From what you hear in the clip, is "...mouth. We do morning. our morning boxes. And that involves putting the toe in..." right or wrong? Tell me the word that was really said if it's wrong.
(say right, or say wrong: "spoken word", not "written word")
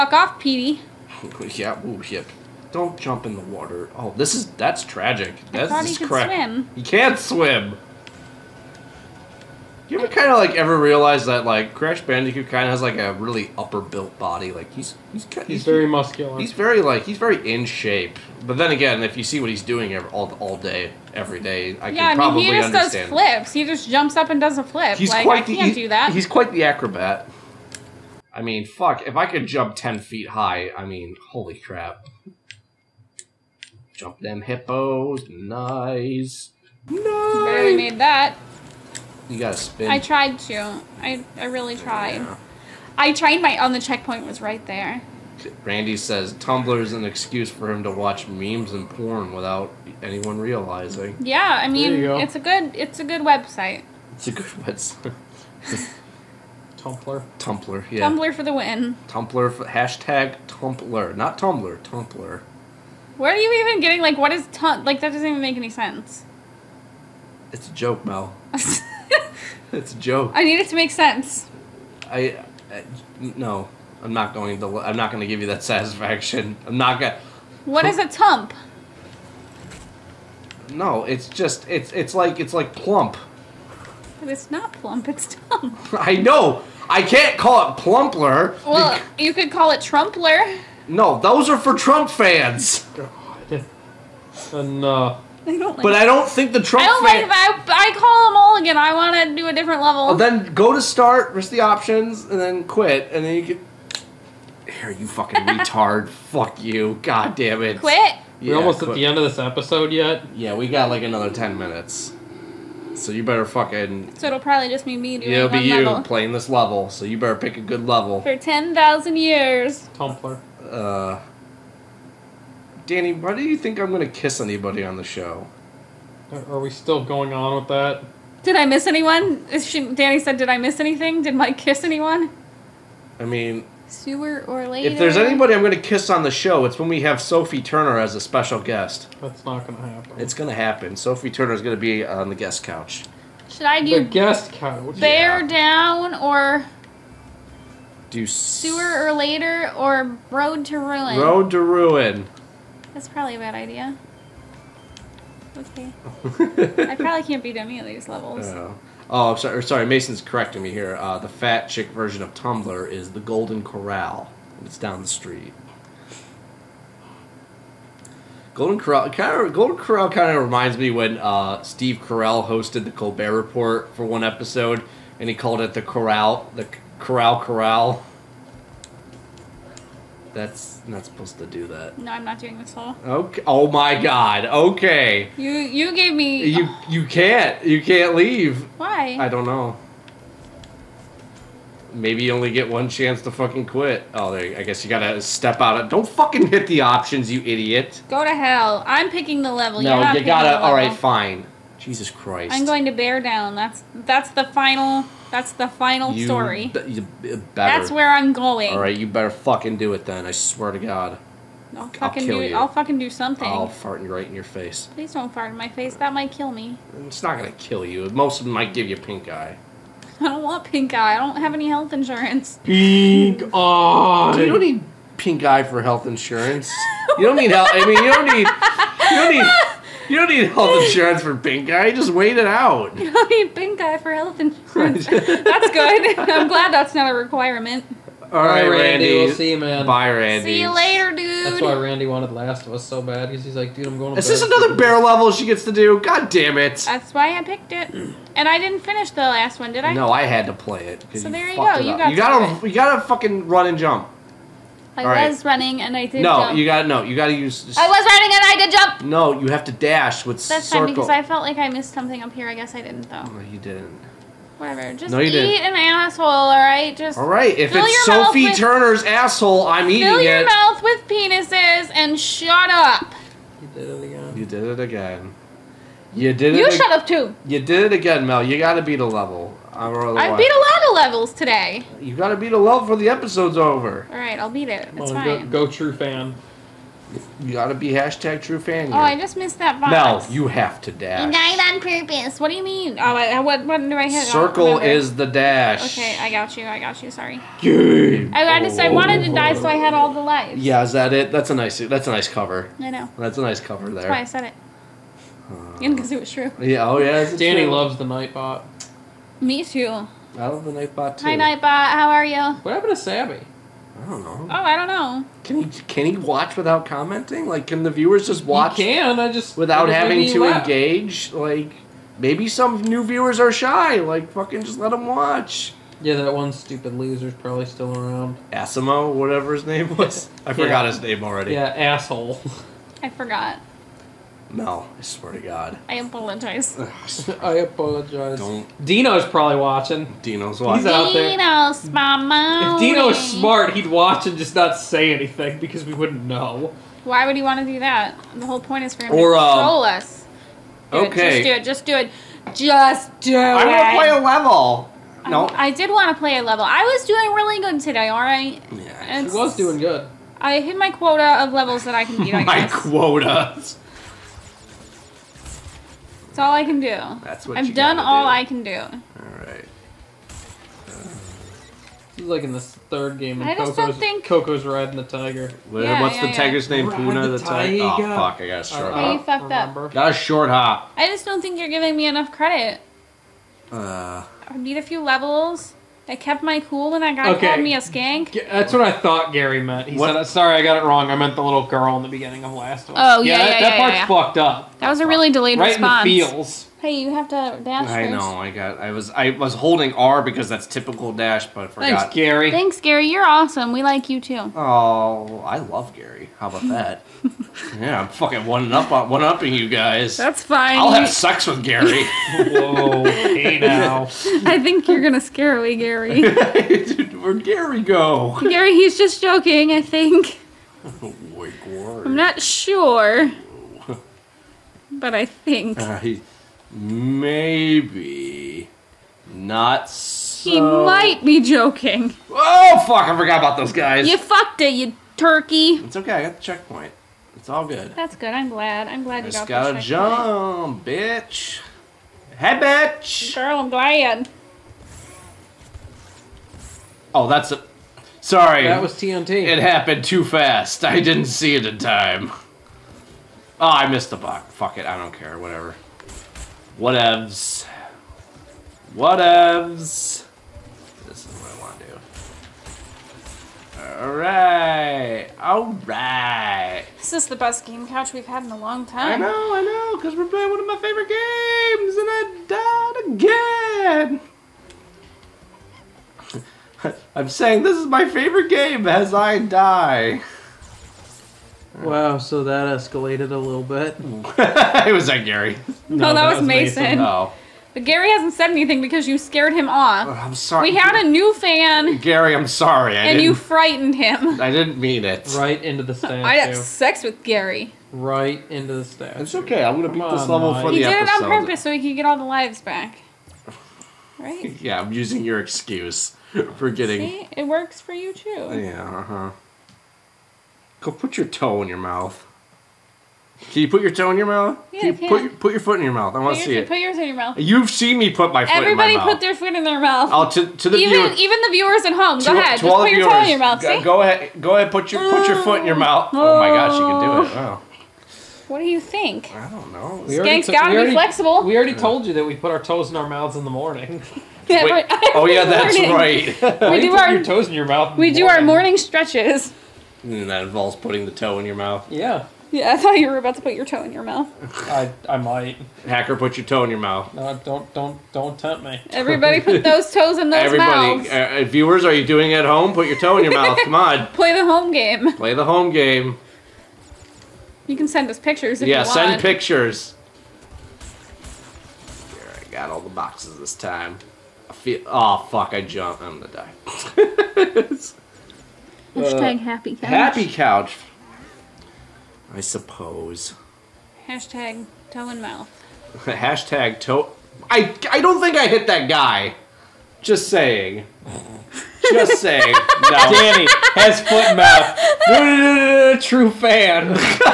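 wrong: "stretches", not "boxes".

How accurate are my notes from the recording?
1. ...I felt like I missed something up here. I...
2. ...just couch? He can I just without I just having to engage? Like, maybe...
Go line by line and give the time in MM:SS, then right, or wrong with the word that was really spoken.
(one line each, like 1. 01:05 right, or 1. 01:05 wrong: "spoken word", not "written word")
1. 04:21 right
2. 05:18 wrong: "watch", not "couch".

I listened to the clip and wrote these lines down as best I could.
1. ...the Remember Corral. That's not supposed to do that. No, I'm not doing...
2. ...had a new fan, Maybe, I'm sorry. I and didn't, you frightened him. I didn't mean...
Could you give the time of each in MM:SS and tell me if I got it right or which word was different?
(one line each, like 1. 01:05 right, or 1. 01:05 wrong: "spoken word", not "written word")
1. 02:56 wrong: "Corral", not "Remember"
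2. 08:10 wrong: "Gary", not "Maybe".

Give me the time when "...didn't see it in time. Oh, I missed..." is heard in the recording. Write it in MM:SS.
07:31.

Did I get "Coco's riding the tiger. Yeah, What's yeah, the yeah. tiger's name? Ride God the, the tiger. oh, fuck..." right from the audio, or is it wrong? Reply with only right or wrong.
wrong.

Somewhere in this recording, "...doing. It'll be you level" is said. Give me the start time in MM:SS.
01:55.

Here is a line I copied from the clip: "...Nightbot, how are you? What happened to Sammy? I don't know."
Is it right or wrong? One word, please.
right.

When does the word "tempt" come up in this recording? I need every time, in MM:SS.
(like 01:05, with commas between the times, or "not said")
09:08.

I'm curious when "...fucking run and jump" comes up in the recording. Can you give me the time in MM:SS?
04:13.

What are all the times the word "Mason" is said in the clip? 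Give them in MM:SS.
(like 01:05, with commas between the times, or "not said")
02:39, 08:06.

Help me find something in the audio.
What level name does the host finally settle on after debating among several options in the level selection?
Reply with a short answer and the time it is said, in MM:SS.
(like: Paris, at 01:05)
Bear Down, at 03:22.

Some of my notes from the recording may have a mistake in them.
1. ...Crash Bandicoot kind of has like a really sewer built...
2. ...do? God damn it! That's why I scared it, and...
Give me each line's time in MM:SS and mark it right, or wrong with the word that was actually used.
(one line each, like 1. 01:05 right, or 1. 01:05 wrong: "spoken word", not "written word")
1. 00:11 wrong: "upper", not "sewer"
2. 04:05 wrong: "picked", not "scared".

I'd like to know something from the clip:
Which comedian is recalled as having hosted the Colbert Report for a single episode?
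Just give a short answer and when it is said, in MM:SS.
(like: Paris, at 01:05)
Steve Carell, at 02:51.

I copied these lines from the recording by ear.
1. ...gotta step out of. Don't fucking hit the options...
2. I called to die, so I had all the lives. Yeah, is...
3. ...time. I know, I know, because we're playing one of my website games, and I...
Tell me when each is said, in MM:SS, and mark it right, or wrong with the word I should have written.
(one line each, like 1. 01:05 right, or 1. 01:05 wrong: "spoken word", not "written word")
1. 03:14 right
2. 04:58 wrong: "wanted", not "called"
3. 07:48 wrong: "favorite", not "website".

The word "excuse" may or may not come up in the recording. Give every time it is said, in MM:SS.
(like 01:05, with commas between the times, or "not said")
00:47, 08:25.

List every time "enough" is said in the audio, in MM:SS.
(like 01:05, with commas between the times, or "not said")
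01:34, 06:22.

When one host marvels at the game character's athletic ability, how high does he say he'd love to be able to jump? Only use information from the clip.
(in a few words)
10 feet.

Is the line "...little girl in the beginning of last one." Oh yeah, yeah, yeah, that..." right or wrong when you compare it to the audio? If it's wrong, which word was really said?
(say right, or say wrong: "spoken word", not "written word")
right.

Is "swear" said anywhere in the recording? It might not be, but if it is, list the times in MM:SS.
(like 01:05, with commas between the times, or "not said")
03:30, 05:35.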